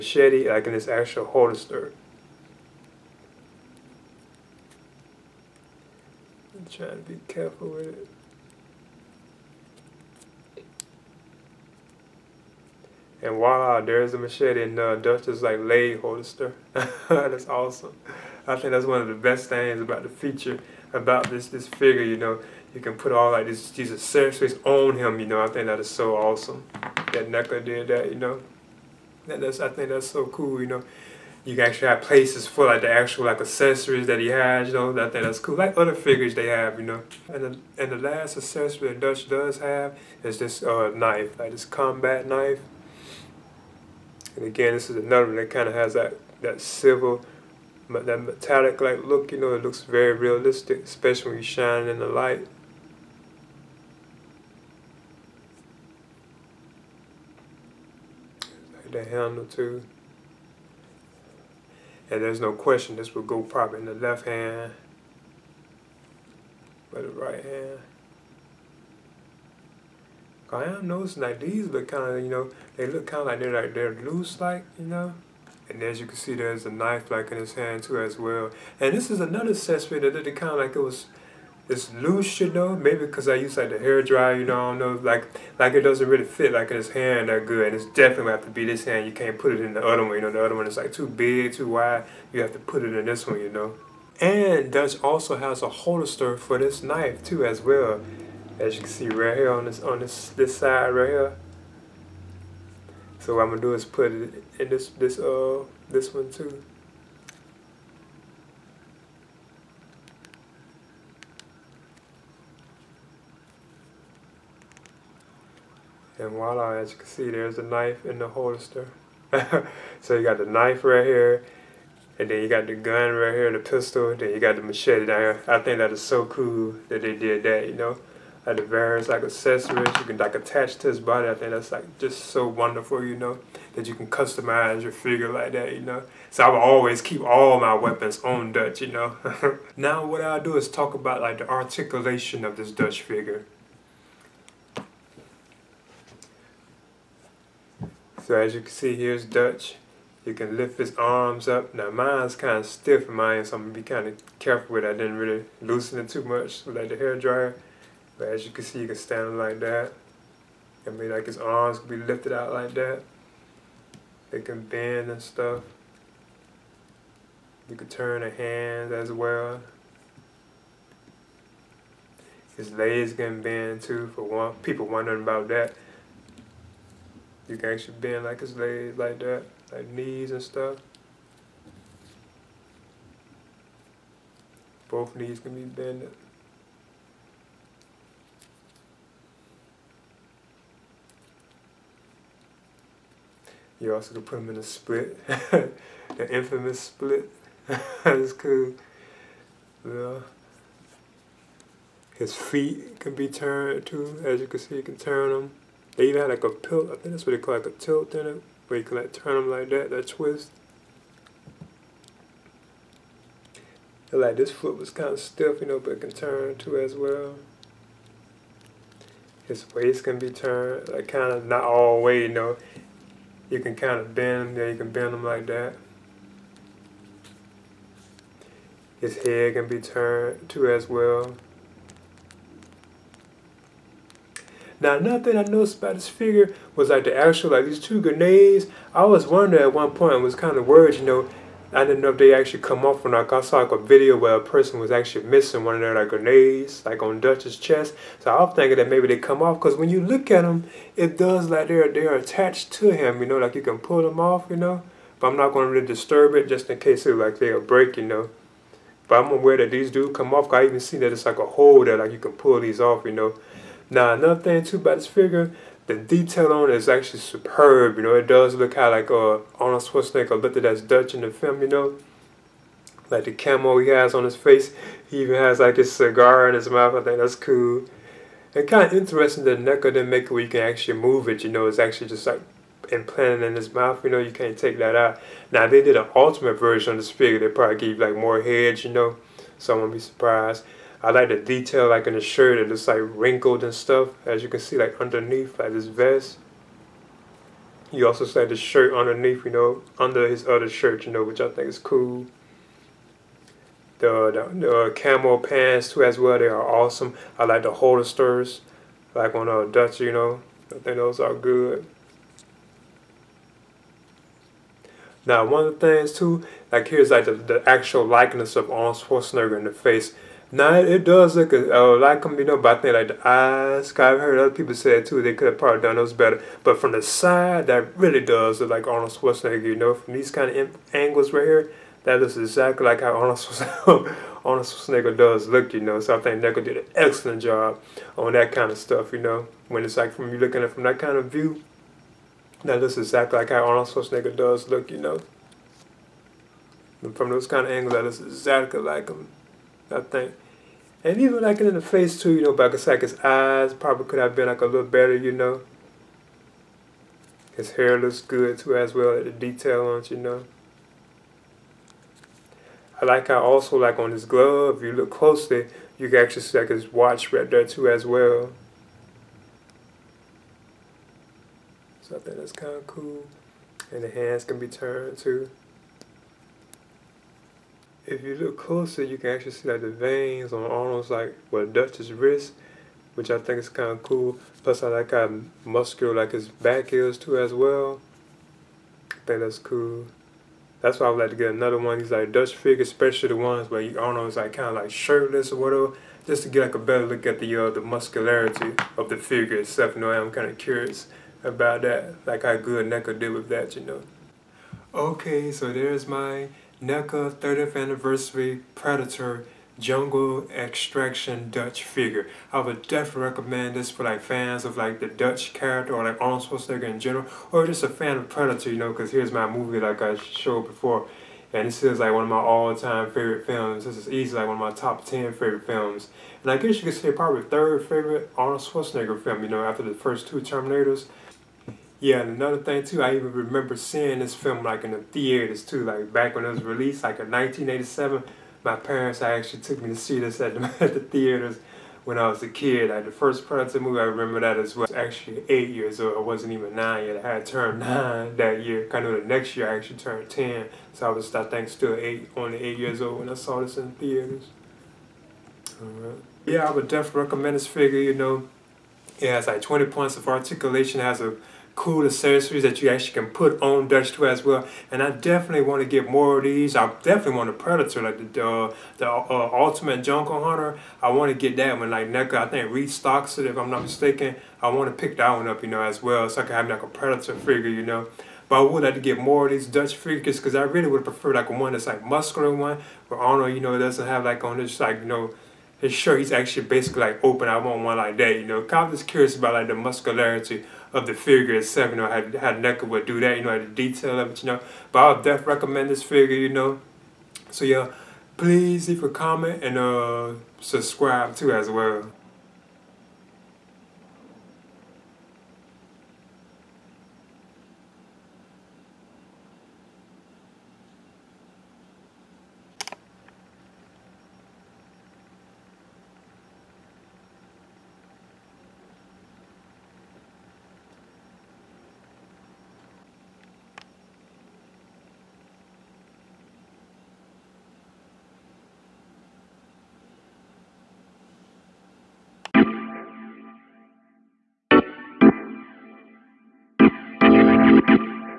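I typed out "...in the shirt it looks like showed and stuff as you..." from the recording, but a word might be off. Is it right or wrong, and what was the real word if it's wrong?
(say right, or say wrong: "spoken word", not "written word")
wrong: "wrinkled", not "showed".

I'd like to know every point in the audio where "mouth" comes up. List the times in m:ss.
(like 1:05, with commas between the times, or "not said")
4:36, 4:43.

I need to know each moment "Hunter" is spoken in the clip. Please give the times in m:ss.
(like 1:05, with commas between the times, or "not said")
7:50.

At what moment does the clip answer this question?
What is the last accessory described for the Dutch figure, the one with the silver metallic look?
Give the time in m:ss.
0:41.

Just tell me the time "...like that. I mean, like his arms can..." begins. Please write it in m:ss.
2:39.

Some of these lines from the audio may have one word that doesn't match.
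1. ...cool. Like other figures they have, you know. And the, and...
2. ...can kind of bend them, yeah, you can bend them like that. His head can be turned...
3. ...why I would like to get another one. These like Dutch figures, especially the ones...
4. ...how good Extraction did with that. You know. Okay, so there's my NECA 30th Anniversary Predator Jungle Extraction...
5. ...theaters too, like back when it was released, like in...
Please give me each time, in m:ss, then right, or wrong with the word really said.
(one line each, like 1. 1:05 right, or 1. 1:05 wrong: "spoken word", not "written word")
1. 0:35 right
2. 3:43 right
3. 6:30 right
4. 6:42 wrong: "NECA", not "Extraction"
5. 7:14 right.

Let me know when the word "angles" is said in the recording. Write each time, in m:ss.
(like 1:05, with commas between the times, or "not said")
5:30, 5:47.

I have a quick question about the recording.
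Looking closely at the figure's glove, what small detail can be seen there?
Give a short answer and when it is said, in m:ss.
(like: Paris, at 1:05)
his watch, at 6:06.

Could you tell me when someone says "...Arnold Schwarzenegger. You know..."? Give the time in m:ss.
5:28.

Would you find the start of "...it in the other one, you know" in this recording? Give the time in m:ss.
1:29.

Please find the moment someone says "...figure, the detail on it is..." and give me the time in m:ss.
4:25.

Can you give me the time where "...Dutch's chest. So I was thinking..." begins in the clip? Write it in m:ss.
4:07.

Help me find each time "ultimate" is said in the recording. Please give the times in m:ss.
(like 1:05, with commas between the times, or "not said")
4:46, 7:49.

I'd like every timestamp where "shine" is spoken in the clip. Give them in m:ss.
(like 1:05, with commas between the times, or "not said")
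0:51.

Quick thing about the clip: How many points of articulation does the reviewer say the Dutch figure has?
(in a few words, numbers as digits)
20.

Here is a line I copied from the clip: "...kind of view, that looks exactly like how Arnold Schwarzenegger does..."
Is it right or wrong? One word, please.
right.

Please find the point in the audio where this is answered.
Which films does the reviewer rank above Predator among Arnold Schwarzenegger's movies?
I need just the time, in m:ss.
7:09.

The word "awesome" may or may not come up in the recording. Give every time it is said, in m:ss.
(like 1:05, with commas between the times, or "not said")
0:17, 0:26, 5:06.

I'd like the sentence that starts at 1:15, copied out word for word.
And as you can see, there's a knife like in his hand too as well.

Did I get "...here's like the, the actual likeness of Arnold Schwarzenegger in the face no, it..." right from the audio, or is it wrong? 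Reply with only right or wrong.
right.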